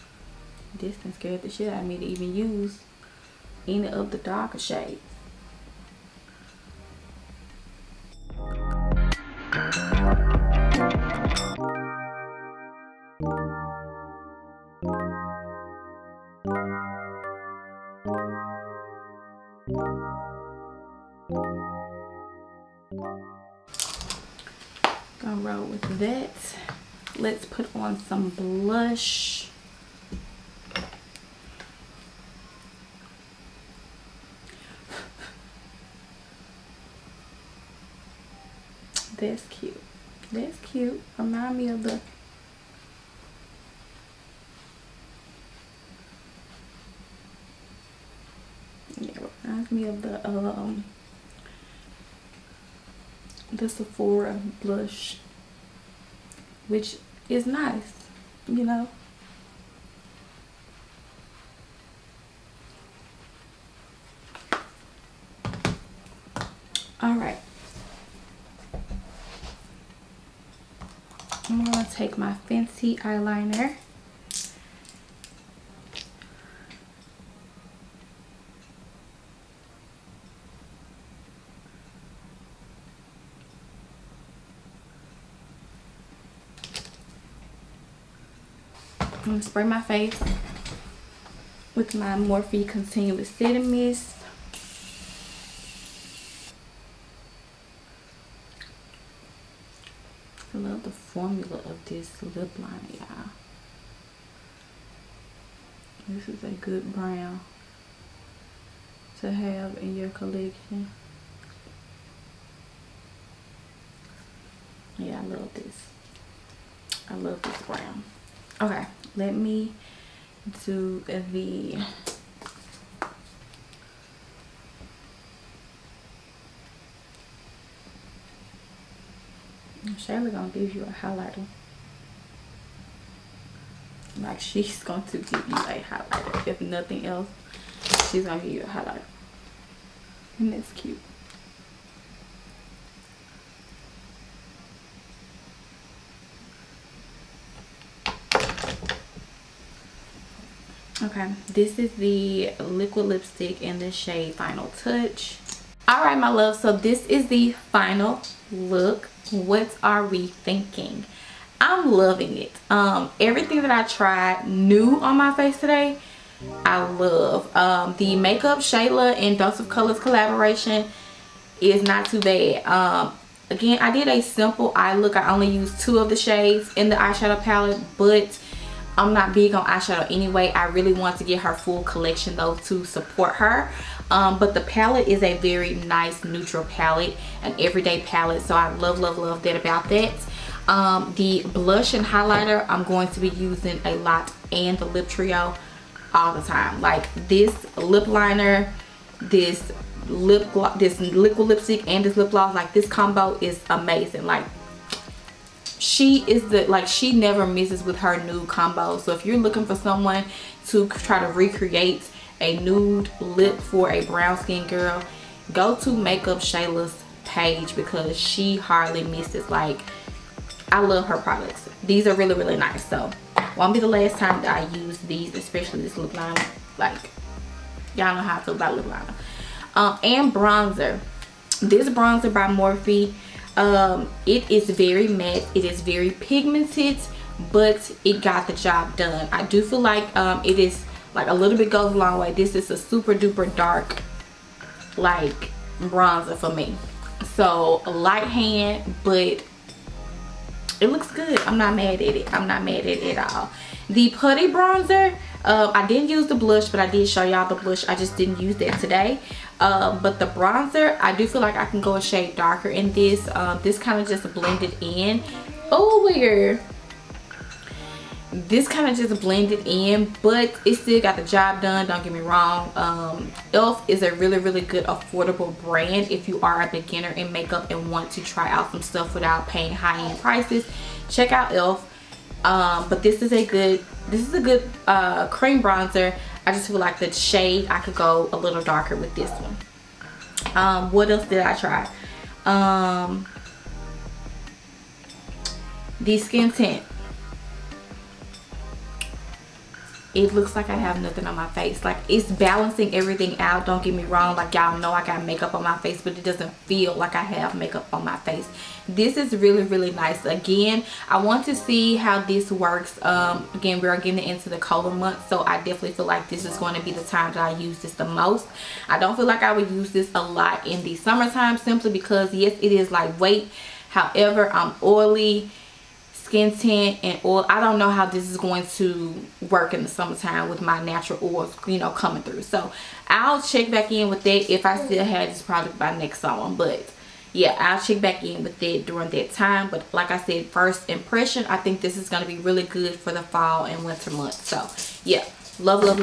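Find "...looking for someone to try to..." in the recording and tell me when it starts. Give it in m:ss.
3:29.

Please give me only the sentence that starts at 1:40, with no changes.
I love the formula of this lip liner, y'all.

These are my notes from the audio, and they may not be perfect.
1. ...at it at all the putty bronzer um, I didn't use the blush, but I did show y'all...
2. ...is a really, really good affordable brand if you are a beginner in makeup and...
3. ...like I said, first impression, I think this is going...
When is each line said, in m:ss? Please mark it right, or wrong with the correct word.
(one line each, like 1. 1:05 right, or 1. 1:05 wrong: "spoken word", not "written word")
1. 4:12 right
2. 4:33 right
3. 5:39 right.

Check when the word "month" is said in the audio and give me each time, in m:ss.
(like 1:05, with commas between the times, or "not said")
5:14, 5:44.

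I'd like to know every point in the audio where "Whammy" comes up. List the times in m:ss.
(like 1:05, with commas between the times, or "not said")
not said.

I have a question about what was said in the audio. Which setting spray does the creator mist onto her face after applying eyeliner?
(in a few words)
Morphe Continuous Setting Mist.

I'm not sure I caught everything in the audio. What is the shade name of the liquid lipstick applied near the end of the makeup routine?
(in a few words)
Final Touch.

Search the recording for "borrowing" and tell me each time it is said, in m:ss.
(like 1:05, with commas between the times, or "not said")
not said.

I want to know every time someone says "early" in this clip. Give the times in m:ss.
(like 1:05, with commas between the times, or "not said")
not said.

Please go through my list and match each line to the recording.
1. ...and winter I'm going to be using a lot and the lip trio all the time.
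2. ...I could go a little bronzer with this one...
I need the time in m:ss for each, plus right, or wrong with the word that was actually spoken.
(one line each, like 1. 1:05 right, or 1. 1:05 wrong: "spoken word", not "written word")
1. 3:11 wrong: "highlighter", not "winter"
2. 4:47 wrong: "darker", not "bronzer".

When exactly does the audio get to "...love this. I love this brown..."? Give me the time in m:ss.
1:55.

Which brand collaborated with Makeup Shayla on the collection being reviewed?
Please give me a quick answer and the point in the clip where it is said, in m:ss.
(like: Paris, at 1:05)
Dose of Colors, at 2:49.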